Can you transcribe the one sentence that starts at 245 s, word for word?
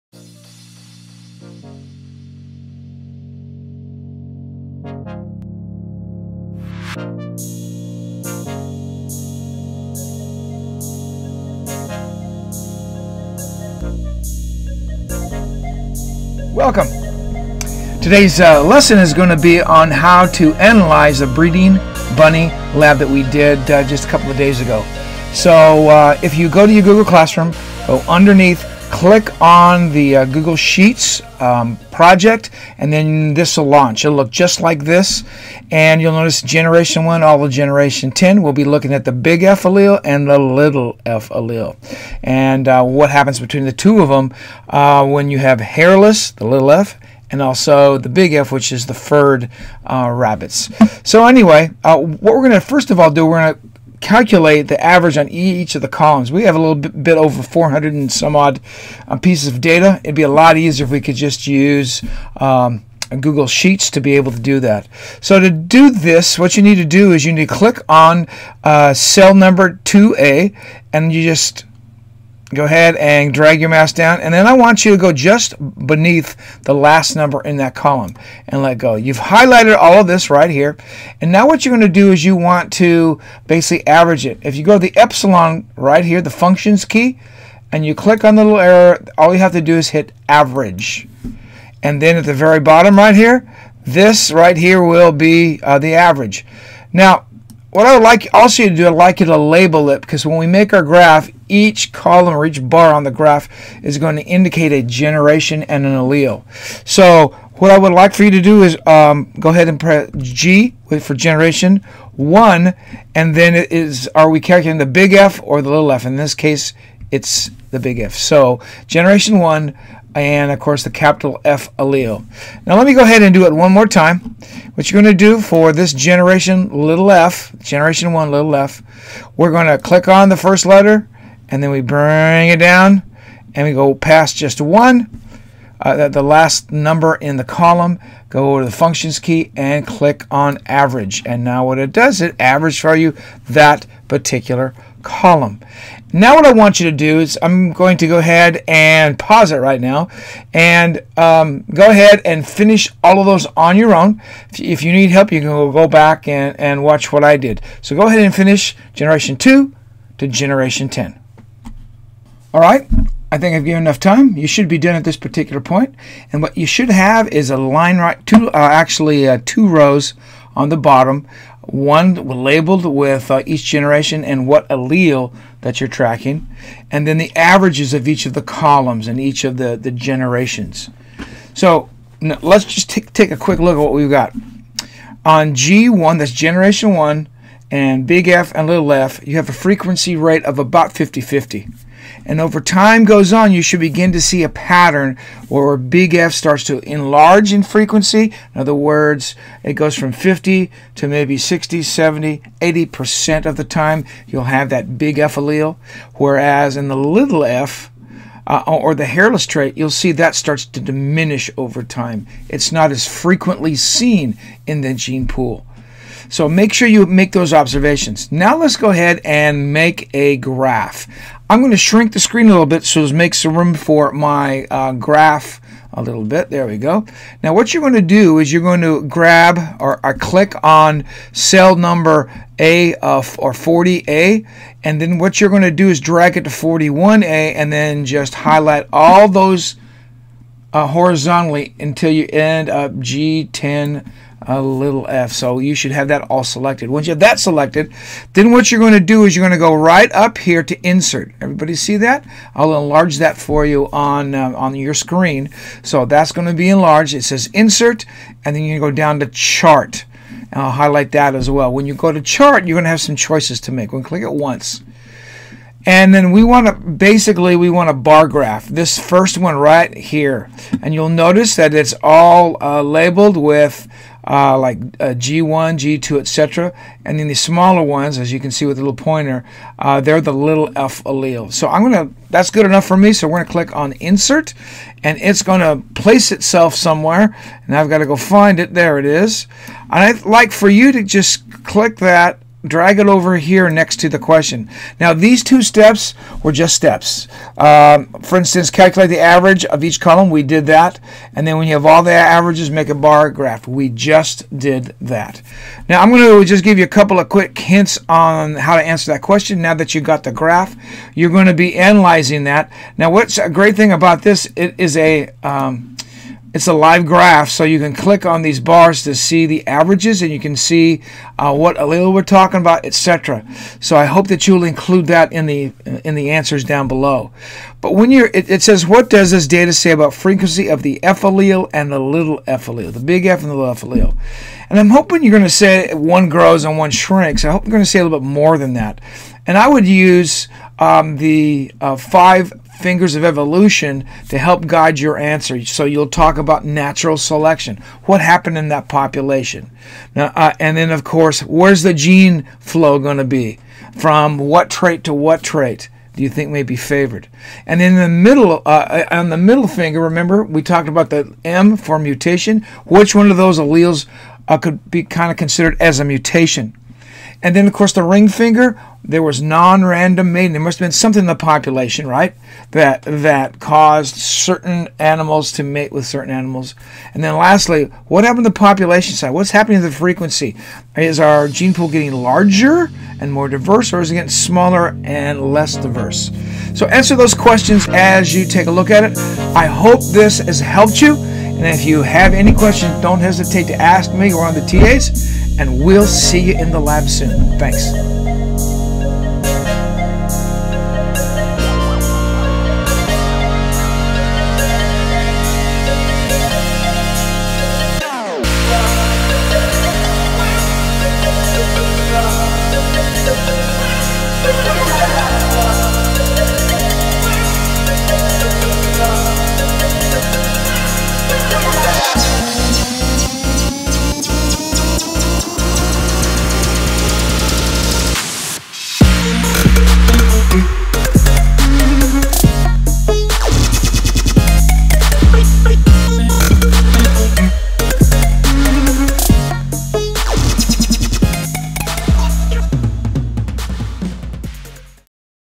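So you should have that all selected.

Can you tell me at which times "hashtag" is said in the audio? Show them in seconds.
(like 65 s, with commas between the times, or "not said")
not said.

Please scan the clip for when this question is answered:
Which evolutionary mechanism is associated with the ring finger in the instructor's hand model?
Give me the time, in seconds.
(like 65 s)
369 s.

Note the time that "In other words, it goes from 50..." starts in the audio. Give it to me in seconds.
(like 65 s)
198 s.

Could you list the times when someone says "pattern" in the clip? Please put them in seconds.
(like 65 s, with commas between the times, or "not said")
194 s.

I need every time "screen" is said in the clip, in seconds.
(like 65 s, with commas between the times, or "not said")
222 s, 254 s.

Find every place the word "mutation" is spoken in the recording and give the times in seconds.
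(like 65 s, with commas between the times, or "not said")
361 s, 366 s.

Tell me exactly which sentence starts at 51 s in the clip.
So anyway, uh, what we're going to first of all do, we're going to calculate the average on each of the columns.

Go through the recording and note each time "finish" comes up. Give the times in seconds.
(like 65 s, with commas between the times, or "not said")
152 s, 158 s.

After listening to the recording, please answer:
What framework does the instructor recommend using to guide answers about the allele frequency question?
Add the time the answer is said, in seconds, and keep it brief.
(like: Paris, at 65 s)
Five fingers of evolution, at 341 s.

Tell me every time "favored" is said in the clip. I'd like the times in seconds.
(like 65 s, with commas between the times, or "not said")
356 s.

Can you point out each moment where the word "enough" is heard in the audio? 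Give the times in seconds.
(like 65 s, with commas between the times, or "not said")
163 s, 282 s.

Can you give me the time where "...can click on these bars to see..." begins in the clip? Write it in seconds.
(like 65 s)
317 s.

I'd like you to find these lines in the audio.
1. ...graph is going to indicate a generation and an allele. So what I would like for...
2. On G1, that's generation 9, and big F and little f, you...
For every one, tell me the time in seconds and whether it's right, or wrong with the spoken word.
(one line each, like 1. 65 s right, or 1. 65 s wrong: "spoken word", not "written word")
1. 103 s right
2. 185 s wrong: "1", not "9".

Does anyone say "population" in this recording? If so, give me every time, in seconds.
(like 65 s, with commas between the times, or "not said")
348 s, 371 s, 378 s.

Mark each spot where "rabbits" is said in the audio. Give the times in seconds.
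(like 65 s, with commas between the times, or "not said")
50 s.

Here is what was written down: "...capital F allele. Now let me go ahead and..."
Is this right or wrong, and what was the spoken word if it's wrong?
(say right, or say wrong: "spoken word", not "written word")
right.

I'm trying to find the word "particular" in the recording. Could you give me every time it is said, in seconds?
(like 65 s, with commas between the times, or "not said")
144 s, 165 s.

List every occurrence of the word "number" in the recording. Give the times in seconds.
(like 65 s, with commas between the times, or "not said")
69 s, 77 s, 136 s, 231 s.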